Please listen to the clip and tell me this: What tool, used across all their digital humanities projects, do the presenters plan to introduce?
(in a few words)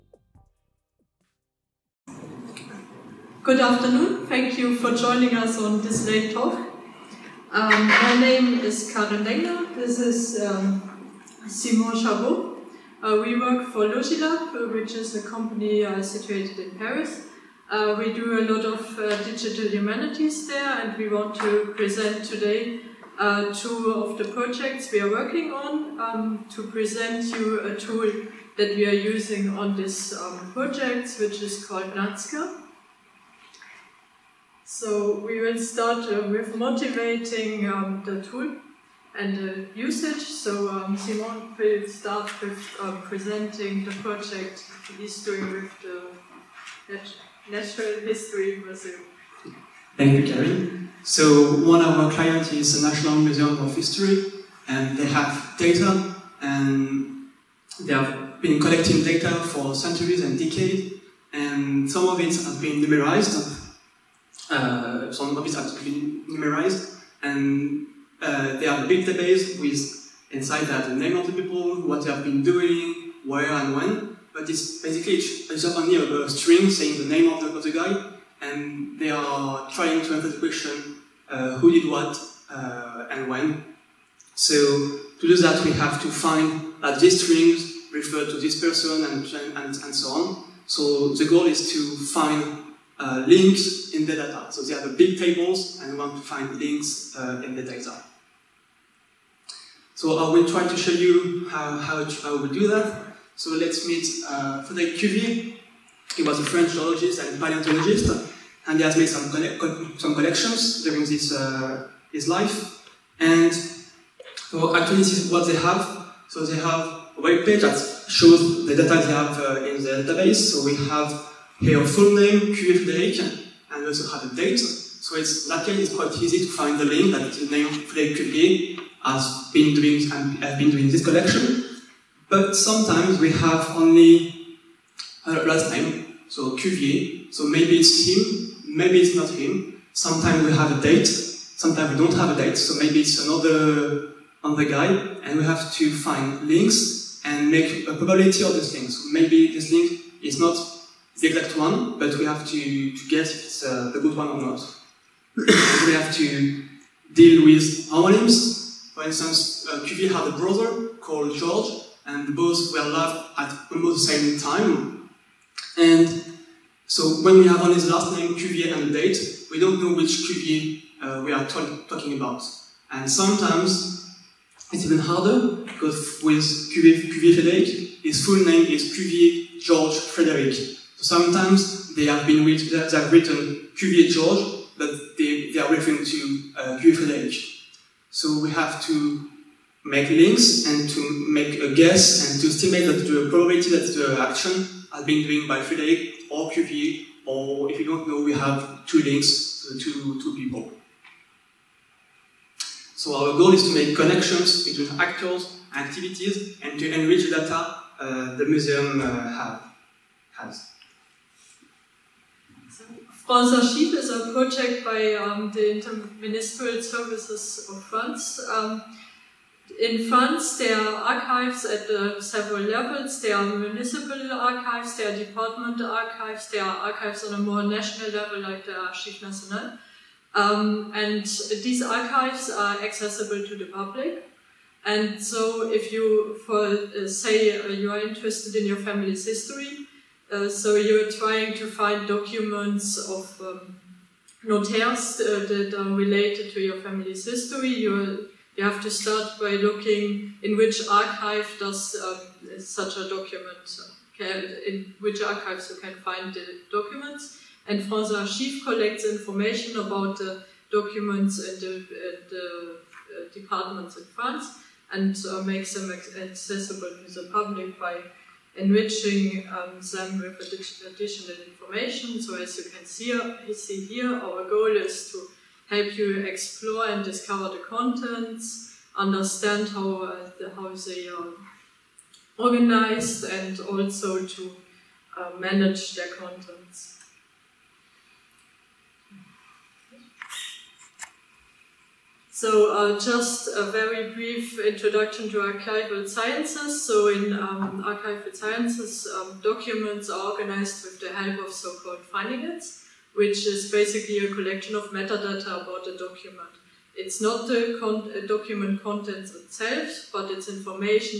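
Nazca.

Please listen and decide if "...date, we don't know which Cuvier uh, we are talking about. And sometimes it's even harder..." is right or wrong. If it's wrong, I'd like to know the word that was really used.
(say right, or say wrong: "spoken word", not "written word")
right.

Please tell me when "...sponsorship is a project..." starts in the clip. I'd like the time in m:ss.
3:33.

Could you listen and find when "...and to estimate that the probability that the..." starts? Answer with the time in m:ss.
3:12.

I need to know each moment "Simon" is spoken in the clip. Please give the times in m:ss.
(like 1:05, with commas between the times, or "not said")
0:11, 0:40.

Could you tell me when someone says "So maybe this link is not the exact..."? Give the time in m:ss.
2:29.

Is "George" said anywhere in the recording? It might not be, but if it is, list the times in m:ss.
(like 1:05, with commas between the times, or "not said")
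2:41, 2:59, 3:04.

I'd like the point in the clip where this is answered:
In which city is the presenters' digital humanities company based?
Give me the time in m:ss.
0:16.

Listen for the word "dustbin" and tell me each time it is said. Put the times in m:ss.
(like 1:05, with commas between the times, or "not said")
not said.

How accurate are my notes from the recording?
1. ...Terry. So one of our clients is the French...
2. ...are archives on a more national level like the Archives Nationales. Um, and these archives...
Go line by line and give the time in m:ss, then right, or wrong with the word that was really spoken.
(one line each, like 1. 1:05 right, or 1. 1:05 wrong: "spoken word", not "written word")
1. 0:50 wrong: "National", not "French"
2. 3:46 right.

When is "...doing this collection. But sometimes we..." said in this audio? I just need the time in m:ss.
2:10.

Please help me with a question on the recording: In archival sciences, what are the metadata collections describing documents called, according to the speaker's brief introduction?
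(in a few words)
findings.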